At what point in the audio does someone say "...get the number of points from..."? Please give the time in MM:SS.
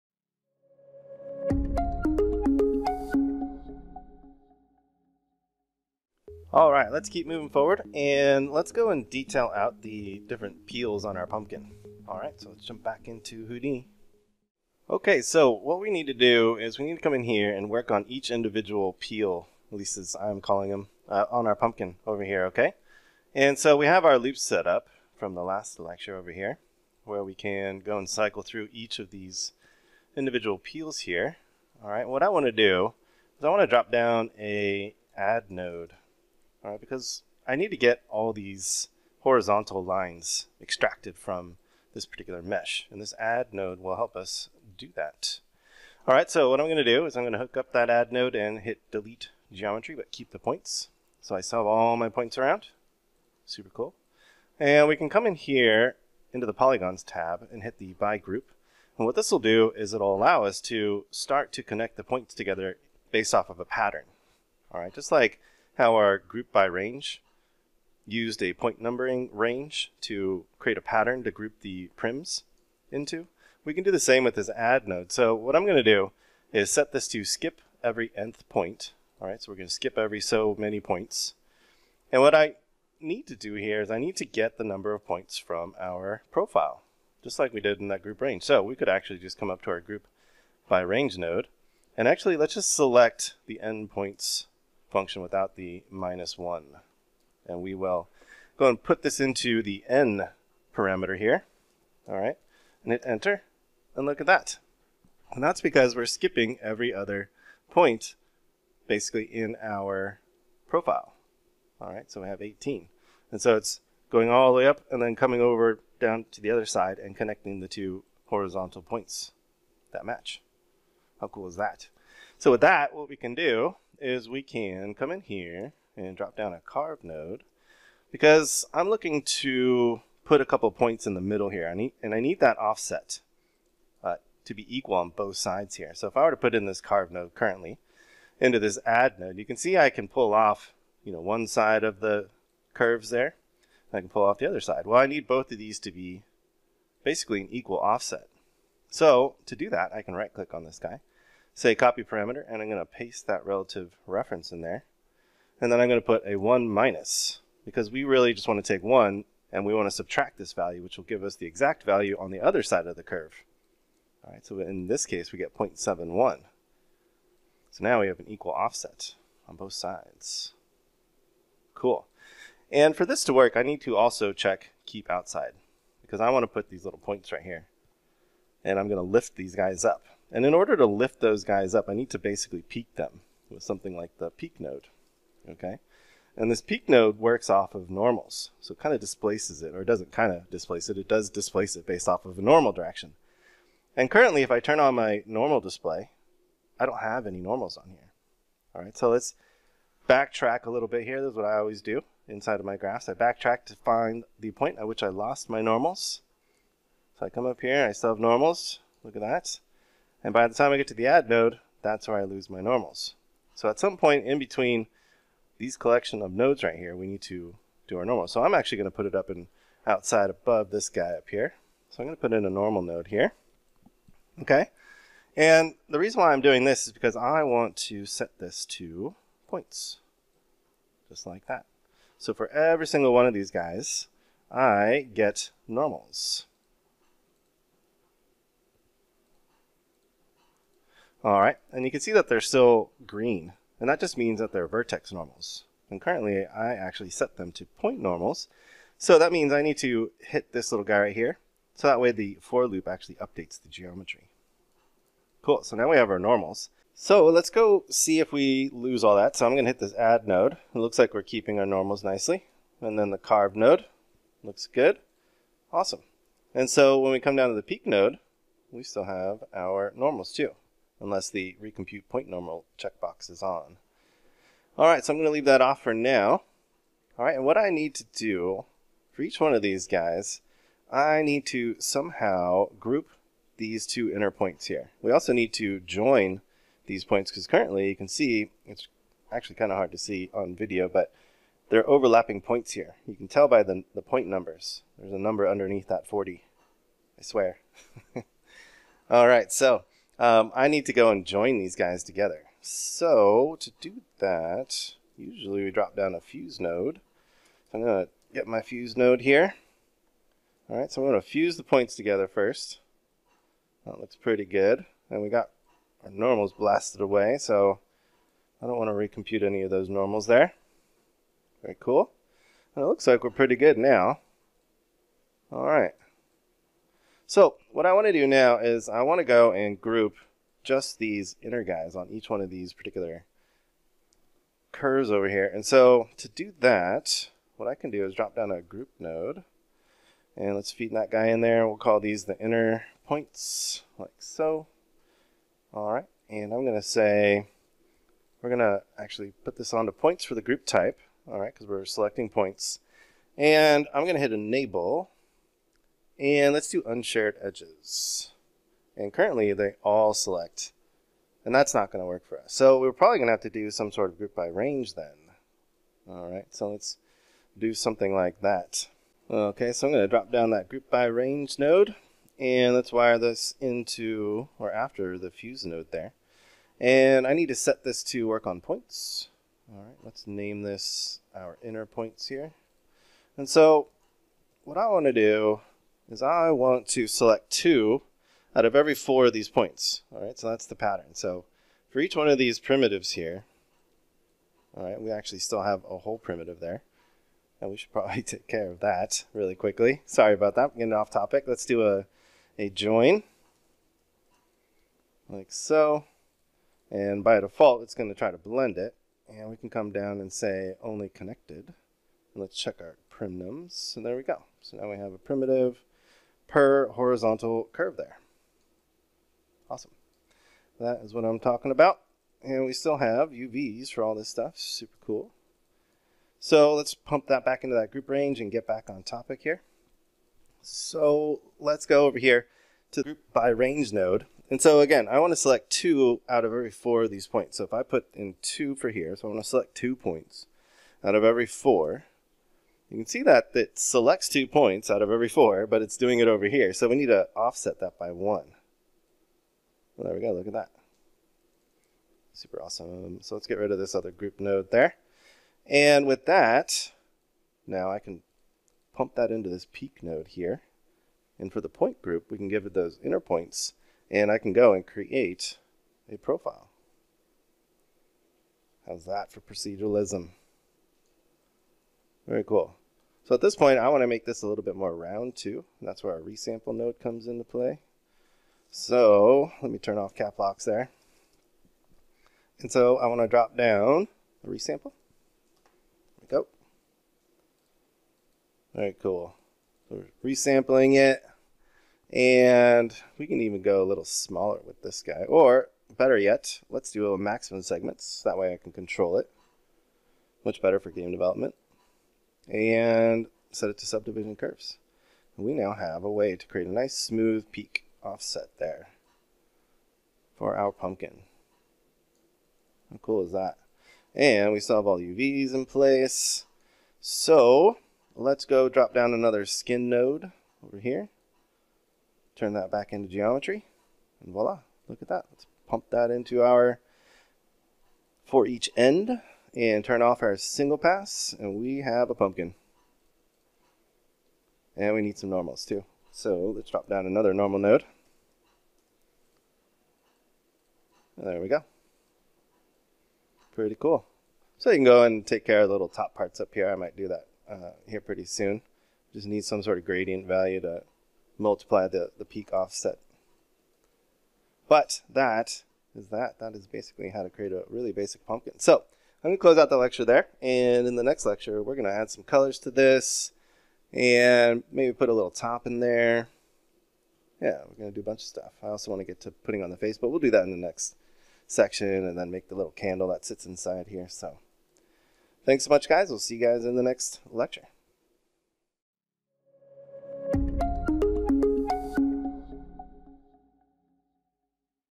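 01:24.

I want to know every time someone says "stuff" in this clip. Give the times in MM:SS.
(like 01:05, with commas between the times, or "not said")
07:04, 09:28.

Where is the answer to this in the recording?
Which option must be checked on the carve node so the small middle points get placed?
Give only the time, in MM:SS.
02:54.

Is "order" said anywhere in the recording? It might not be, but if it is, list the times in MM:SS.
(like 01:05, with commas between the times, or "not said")
03:00.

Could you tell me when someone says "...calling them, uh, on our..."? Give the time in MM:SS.
00:20.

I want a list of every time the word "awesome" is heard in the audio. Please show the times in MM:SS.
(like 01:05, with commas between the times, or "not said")
04:25, 06:59, 07:32.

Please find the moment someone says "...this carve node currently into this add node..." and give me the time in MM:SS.
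02:16.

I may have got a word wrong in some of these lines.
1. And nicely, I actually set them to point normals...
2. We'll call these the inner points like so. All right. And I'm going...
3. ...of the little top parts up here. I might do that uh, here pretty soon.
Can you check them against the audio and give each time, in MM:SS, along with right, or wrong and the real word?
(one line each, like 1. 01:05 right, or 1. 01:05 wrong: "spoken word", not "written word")
1. 04:05 wrong: "currently", not "nicely"
2. 05:41 right
3. 09:05 right.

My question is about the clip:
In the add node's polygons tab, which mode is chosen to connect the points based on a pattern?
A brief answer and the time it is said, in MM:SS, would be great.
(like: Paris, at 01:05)
by group, at 00:57.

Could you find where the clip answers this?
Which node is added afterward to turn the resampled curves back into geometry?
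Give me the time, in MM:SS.
08:39.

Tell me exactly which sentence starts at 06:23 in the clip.
And so what I want to do is I want to select two out of every four of these points.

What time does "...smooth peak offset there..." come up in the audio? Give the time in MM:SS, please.
08:26.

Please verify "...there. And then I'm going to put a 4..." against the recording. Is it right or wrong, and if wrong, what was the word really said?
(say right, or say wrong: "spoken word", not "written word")
wrong: "1", not "4".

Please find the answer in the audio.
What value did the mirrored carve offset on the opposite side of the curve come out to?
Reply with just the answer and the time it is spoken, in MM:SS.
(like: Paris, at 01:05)
0.71, at 02:45.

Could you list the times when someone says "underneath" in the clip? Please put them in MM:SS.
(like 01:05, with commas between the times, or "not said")
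04:55.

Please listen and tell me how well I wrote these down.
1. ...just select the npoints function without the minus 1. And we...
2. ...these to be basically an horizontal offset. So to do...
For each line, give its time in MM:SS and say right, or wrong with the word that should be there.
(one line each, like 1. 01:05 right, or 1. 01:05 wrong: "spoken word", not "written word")
1. 01:32 right
2. 02:25 wrong: "equal", not "horizontal".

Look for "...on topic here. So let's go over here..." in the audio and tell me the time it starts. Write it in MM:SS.
07:08.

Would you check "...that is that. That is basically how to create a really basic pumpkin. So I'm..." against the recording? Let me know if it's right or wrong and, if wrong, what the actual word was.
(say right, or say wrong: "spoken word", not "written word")
right.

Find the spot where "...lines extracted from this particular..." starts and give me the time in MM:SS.
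00:39.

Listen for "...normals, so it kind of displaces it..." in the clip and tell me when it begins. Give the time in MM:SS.
03:07.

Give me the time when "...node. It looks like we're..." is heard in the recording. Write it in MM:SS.
04:20.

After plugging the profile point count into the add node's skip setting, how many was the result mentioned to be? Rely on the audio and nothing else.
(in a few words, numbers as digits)
18.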